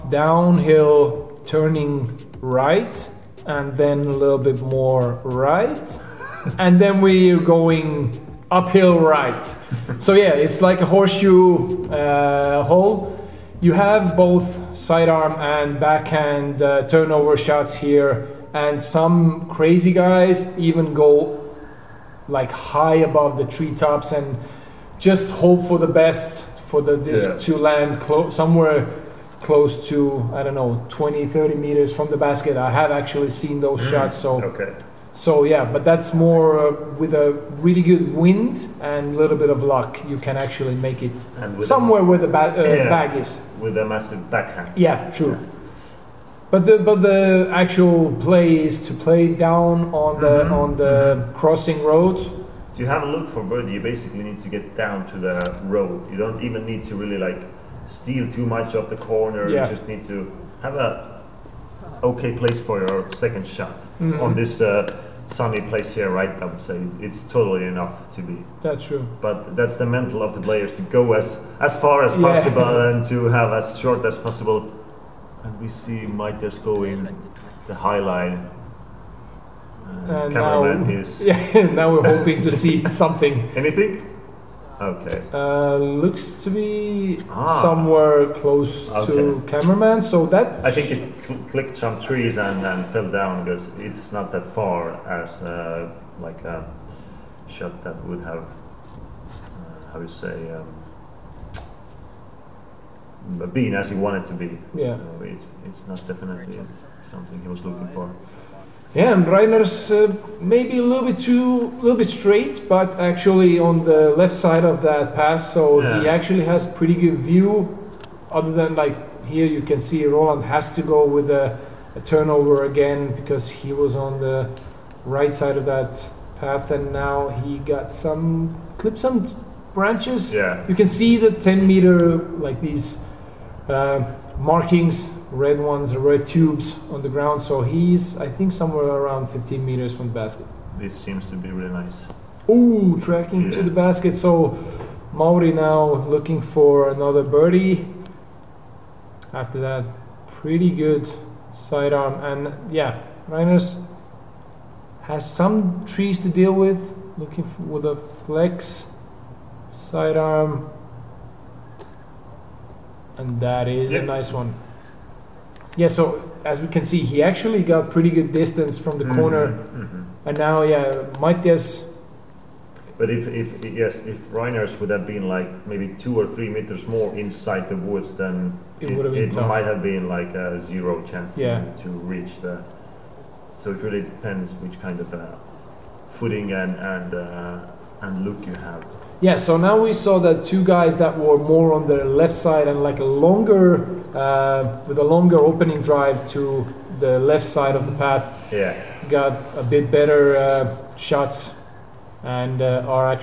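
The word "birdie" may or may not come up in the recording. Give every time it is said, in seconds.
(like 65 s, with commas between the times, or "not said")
53 s, 147 s.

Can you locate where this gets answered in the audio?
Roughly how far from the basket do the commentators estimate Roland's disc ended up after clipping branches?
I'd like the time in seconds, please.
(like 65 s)
139 s.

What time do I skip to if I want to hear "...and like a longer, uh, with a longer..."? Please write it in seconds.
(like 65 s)
192 s.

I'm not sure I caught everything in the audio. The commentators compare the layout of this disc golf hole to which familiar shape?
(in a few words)
Horseshoe.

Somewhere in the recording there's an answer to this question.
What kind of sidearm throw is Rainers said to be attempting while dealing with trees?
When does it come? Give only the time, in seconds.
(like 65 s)
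157 s.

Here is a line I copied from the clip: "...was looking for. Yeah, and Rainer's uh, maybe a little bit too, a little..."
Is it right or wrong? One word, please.
right.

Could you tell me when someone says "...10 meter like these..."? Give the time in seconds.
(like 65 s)
131 s.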